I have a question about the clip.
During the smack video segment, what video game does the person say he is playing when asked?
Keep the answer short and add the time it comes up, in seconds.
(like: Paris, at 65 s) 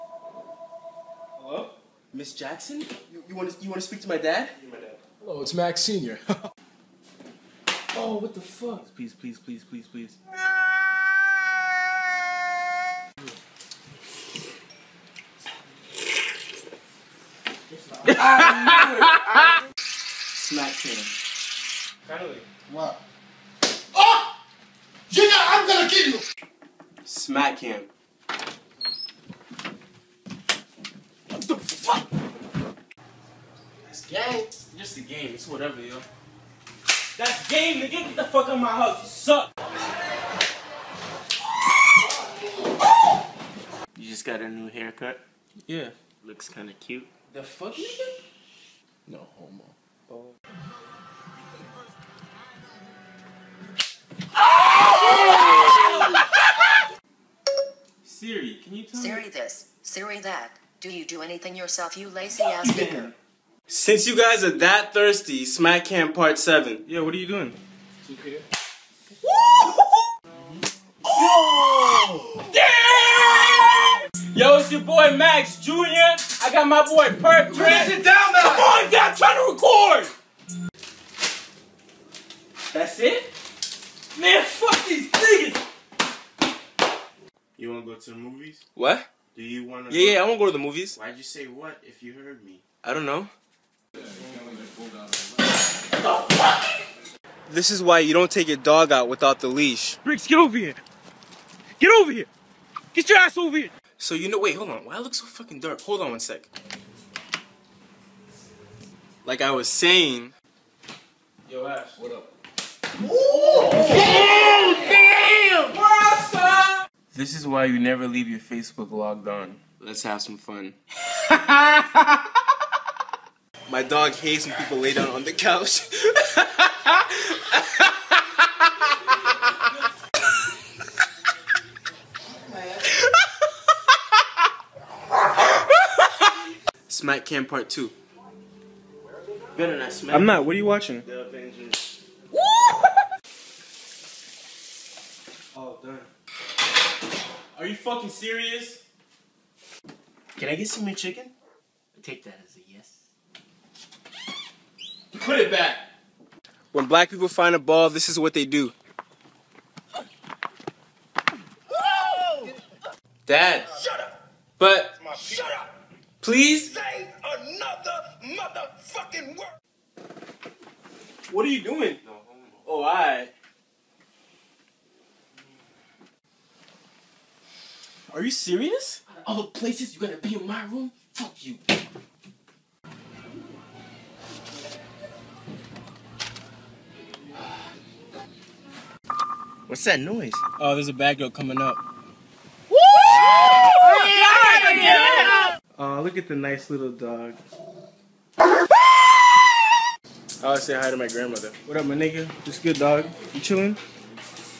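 2K, at 68 s.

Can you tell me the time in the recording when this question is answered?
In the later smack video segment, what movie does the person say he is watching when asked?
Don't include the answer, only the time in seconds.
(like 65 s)
141 s.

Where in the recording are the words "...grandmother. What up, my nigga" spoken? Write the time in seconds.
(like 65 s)
201 s.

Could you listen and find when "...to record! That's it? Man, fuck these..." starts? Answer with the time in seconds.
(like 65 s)
79 s.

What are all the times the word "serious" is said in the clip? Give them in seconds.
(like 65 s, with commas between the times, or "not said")
148 s, 178 s.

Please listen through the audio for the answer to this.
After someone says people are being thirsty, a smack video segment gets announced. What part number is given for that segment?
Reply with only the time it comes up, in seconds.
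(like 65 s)
66 s.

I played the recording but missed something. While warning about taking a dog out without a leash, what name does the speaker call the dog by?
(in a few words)
Briggs.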